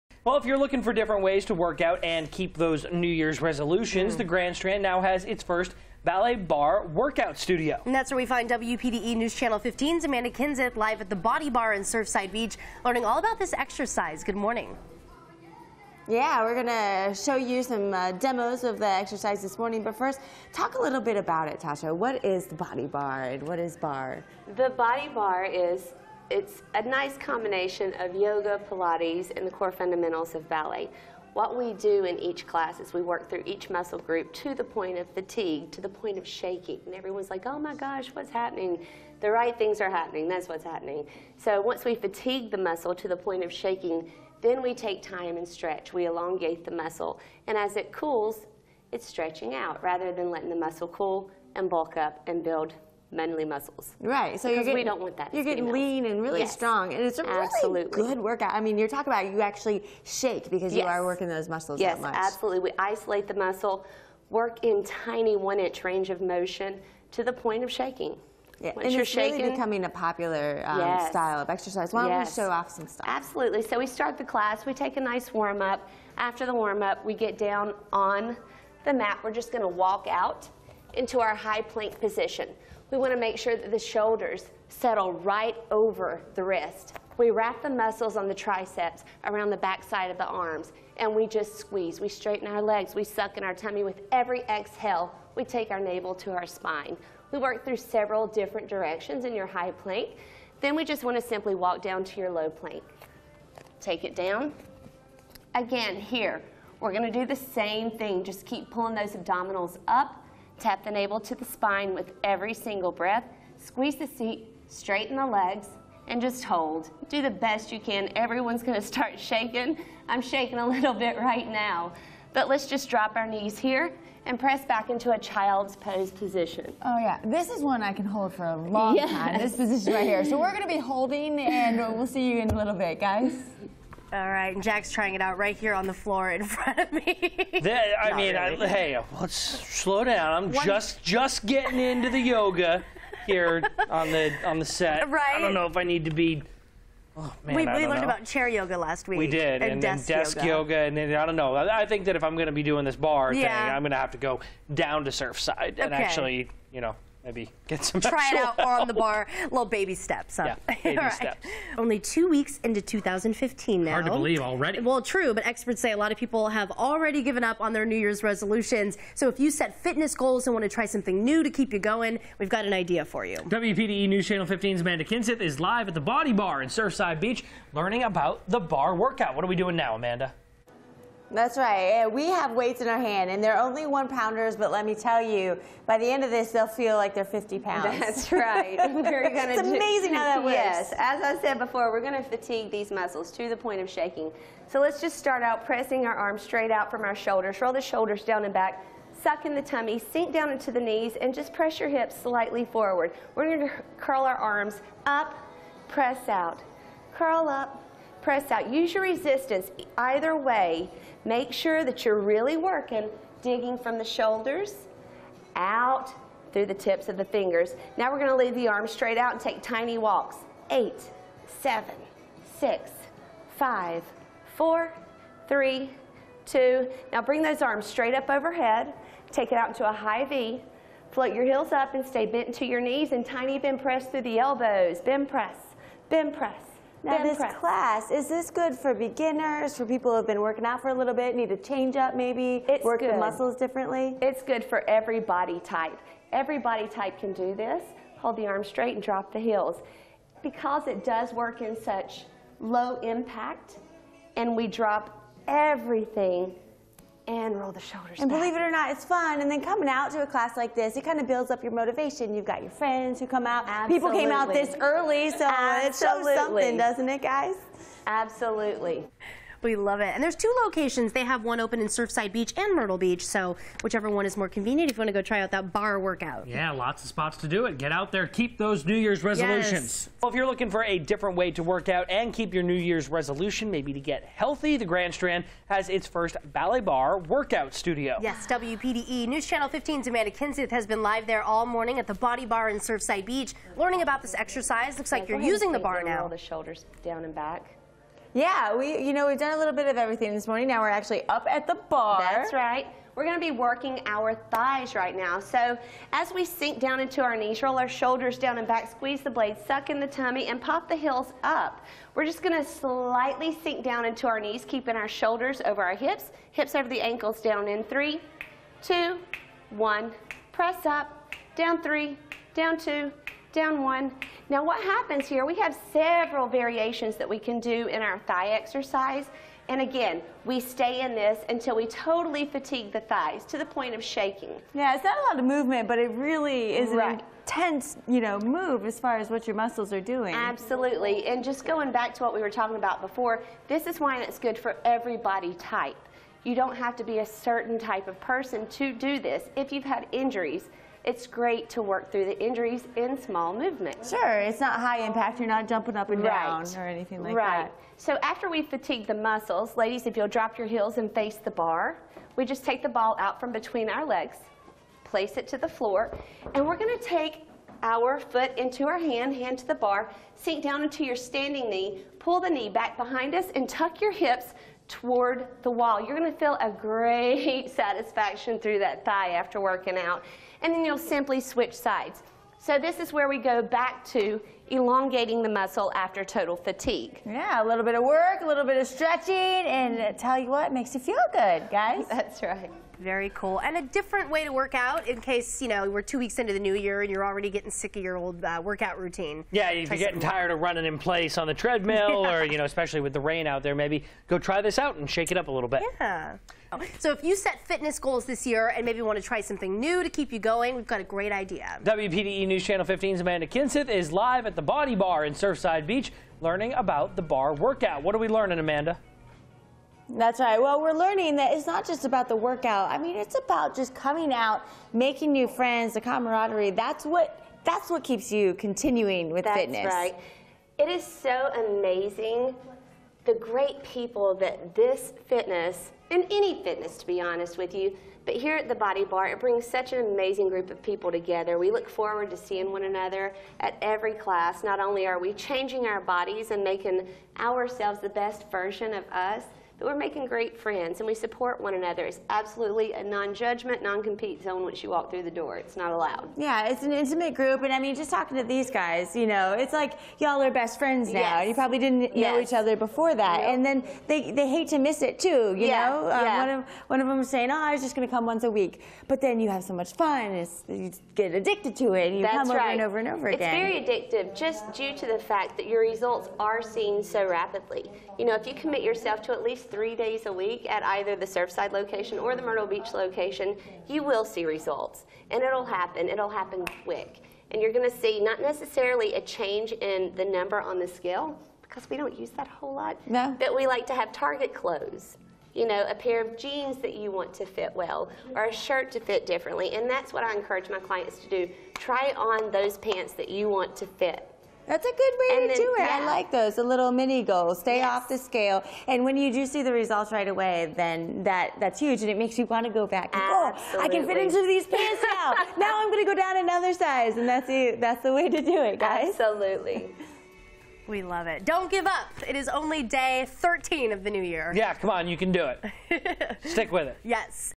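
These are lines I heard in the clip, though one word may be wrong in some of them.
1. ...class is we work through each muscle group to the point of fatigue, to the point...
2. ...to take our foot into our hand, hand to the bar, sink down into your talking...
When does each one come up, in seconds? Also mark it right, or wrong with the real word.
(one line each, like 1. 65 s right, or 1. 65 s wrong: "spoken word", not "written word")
1. 32 s right
2. 366 s wrong: "standing", not "talking".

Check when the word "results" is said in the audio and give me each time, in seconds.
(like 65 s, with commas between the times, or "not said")
475 s, 484 s, 509 s.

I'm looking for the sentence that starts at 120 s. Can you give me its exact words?
I'm shaking a little bit right now.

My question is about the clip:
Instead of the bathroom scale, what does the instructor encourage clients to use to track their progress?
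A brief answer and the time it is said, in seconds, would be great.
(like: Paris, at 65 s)
target clothes, at 494 s.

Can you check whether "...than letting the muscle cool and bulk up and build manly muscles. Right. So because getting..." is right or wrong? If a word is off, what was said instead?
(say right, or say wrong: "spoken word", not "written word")
right.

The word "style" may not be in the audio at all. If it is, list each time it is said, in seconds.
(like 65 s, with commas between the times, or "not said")
71 s.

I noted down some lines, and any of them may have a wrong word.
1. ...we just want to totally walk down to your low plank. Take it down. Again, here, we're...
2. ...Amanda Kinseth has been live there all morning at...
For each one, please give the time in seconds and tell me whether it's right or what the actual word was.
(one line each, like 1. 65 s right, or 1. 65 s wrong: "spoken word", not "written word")
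1. 100 s wrong: "simply", not "totally"
2. 290 s right.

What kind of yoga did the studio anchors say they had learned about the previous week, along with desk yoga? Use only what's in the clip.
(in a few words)
chair yoga.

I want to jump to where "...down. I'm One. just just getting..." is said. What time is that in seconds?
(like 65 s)
140 s.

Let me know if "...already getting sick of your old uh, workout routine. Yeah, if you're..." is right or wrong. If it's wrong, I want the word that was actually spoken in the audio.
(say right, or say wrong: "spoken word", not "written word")
right.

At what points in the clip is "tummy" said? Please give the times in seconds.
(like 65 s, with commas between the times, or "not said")
93 s, 199 s, 310 s.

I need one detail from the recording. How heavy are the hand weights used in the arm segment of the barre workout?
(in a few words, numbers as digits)
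1 pound.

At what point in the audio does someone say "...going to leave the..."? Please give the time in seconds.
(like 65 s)
218 s.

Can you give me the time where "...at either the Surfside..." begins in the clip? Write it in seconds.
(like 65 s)
480 s.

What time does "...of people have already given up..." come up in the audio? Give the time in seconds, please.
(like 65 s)
166 s.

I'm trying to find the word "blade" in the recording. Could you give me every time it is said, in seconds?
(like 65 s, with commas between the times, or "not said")
309 s.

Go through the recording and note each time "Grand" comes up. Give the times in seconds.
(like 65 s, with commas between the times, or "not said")
4 s, 284 s.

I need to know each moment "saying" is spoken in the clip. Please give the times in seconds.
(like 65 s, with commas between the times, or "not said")
467 s.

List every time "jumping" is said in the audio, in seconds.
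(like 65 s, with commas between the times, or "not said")
355 s.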